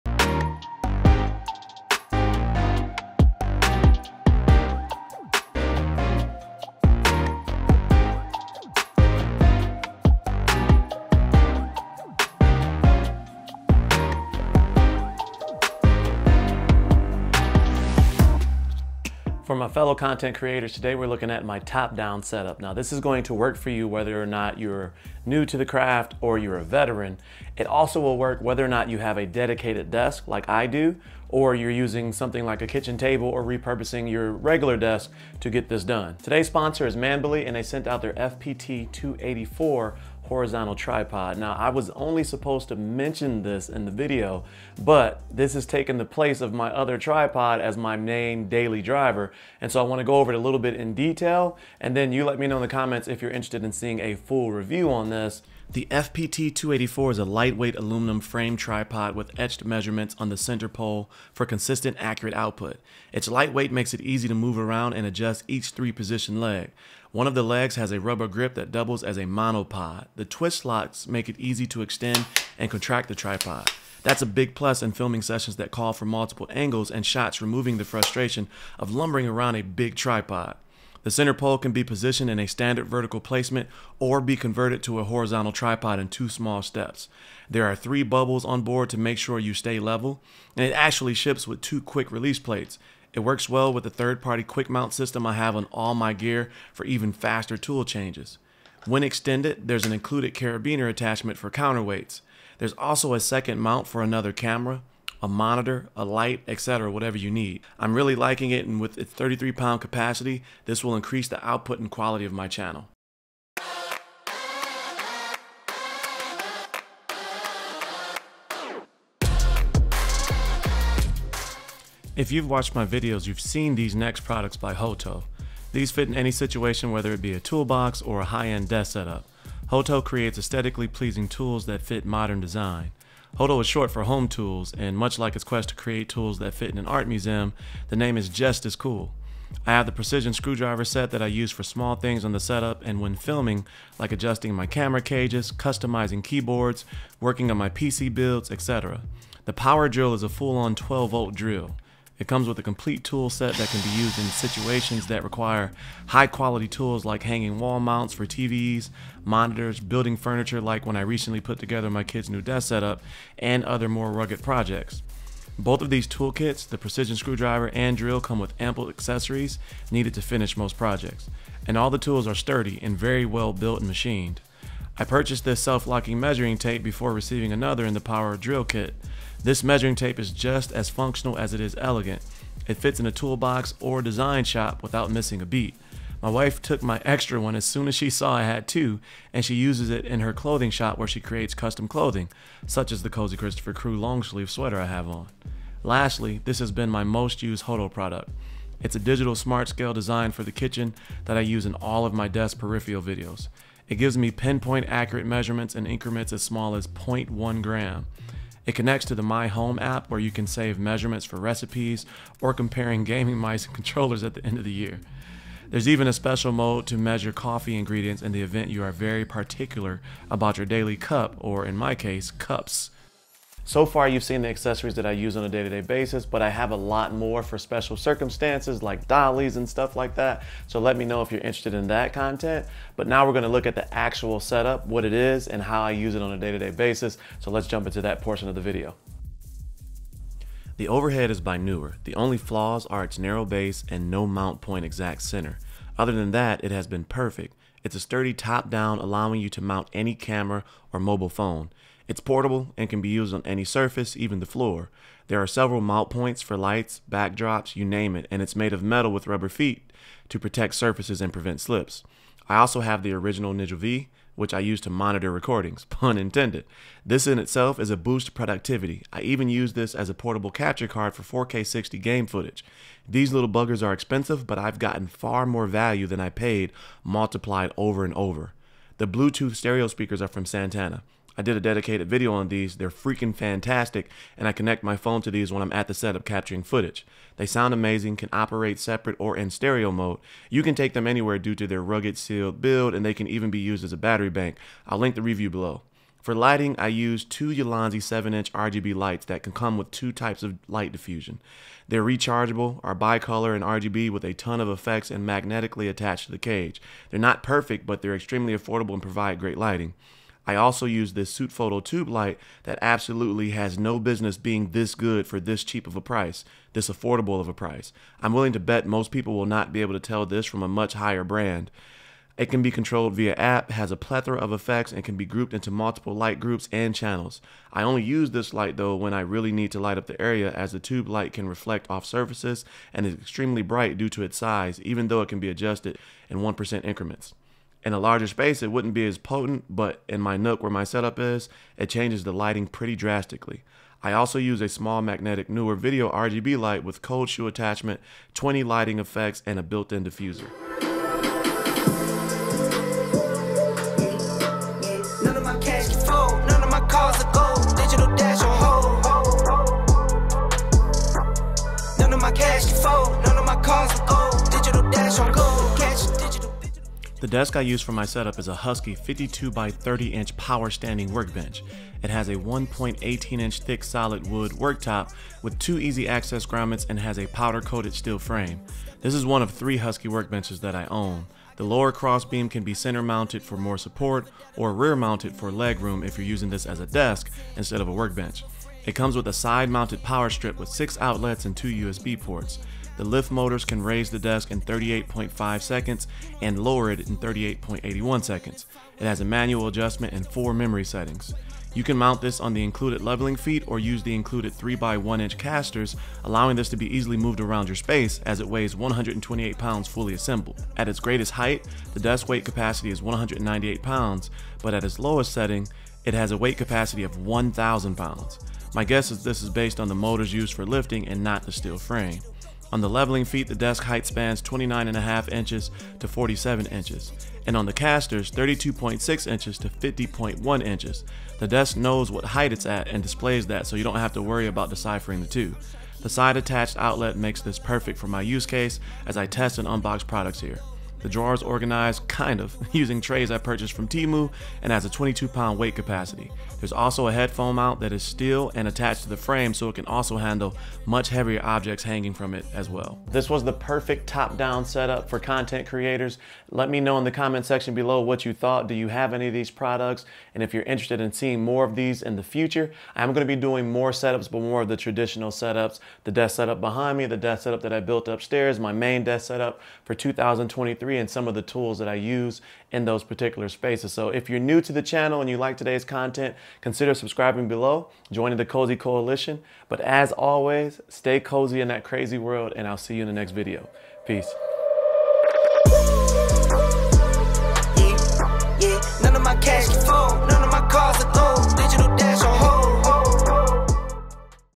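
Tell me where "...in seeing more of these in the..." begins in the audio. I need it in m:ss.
7:41.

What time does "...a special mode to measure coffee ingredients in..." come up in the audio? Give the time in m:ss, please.
3:36.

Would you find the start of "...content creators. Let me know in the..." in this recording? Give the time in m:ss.
7:35.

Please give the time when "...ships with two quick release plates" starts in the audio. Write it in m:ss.
1:31.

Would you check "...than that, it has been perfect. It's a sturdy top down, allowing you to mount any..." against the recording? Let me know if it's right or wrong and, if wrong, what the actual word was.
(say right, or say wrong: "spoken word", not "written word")
right.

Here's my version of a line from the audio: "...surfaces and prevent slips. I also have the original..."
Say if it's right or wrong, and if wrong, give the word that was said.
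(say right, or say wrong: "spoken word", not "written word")
right.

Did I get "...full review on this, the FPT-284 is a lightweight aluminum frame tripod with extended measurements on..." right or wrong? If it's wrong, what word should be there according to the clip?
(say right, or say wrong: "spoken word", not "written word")
wrong: "etched", not "extended".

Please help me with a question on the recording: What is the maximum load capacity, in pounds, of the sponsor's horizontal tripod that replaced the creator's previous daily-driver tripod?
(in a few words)
33 pounds.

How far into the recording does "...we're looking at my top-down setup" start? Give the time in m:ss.
0:20.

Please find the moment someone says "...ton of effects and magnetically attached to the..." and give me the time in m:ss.
5:04.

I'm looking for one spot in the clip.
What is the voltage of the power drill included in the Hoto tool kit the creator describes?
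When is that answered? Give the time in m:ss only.
2:30.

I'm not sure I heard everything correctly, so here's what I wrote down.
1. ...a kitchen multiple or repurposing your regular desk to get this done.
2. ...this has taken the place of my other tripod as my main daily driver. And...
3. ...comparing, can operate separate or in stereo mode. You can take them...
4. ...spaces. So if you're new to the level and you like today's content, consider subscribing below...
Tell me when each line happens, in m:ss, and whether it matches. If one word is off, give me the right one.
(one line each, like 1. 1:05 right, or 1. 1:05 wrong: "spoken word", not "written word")
1. 0:32 wrong: "table", not "multiple"
2. 0:45 right
3. 4:47 wrong: "amazing", not "comparing"
4. 7:53 wrong: "channel", not "level".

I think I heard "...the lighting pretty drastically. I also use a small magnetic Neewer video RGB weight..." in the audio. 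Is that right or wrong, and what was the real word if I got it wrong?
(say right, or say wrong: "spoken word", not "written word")
wrong: "light", not "weight".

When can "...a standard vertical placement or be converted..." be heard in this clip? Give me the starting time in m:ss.
1:22.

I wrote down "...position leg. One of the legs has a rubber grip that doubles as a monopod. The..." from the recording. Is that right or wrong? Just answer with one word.
right.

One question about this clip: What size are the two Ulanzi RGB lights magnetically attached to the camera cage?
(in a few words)
7-inch.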